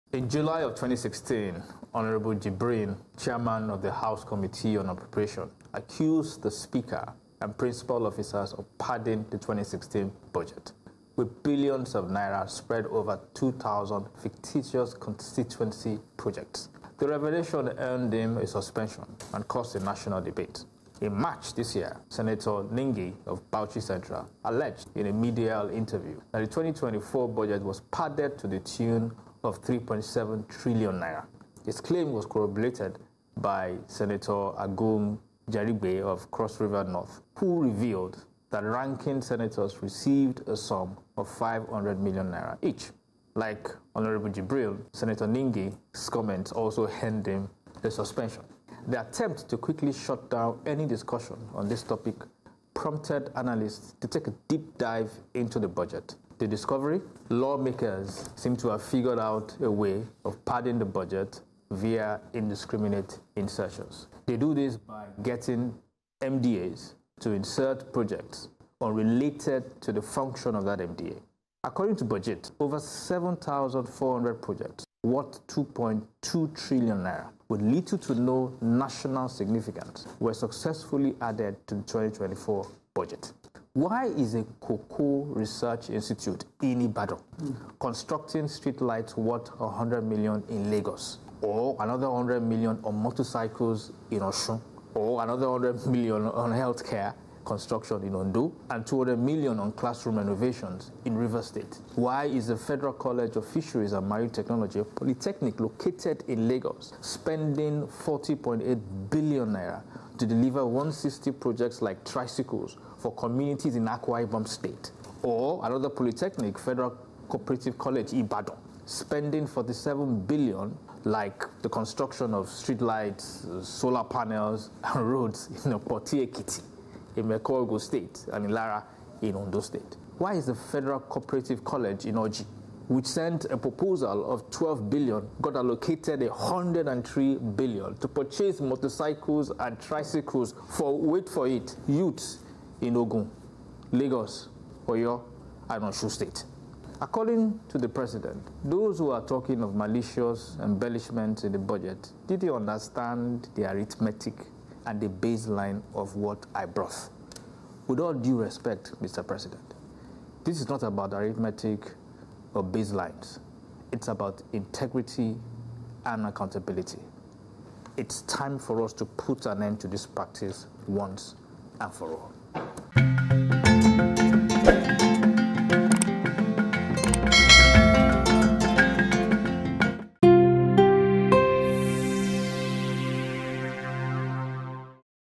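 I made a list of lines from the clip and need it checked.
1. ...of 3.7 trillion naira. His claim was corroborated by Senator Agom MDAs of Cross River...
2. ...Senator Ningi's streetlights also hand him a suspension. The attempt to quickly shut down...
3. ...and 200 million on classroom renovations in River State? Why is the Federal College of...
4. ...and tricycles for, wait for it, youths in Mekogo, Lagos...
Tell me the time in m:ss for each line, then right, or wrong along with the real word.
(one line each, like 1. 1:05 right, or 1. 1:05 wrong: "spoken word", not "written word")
1. 0:29 wrong: "Jarigbe", not "MDAs"
2. 0:44 wrong: "comments", not "streetlights"
3. 1:38 right
4. 2:19 wrong: "Ogun", not "Mekogo".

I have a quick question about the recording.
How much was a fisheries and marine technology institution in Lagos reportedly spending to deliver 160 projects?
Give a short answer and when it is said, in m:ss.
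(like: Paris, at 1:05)
40.8 billion naira, at 1:47.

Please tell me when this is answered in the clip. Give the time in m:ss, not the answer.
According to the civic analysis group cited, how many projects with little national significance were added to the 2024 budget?
1:12.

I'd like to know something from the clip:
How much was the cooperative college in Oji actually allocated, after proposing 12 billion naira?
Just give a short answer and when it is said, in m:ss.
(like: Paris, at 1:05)
103 billion, at 2:16.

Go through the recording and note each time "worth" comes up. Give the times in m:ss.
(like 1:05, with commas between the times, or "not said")
1:15, 1:29.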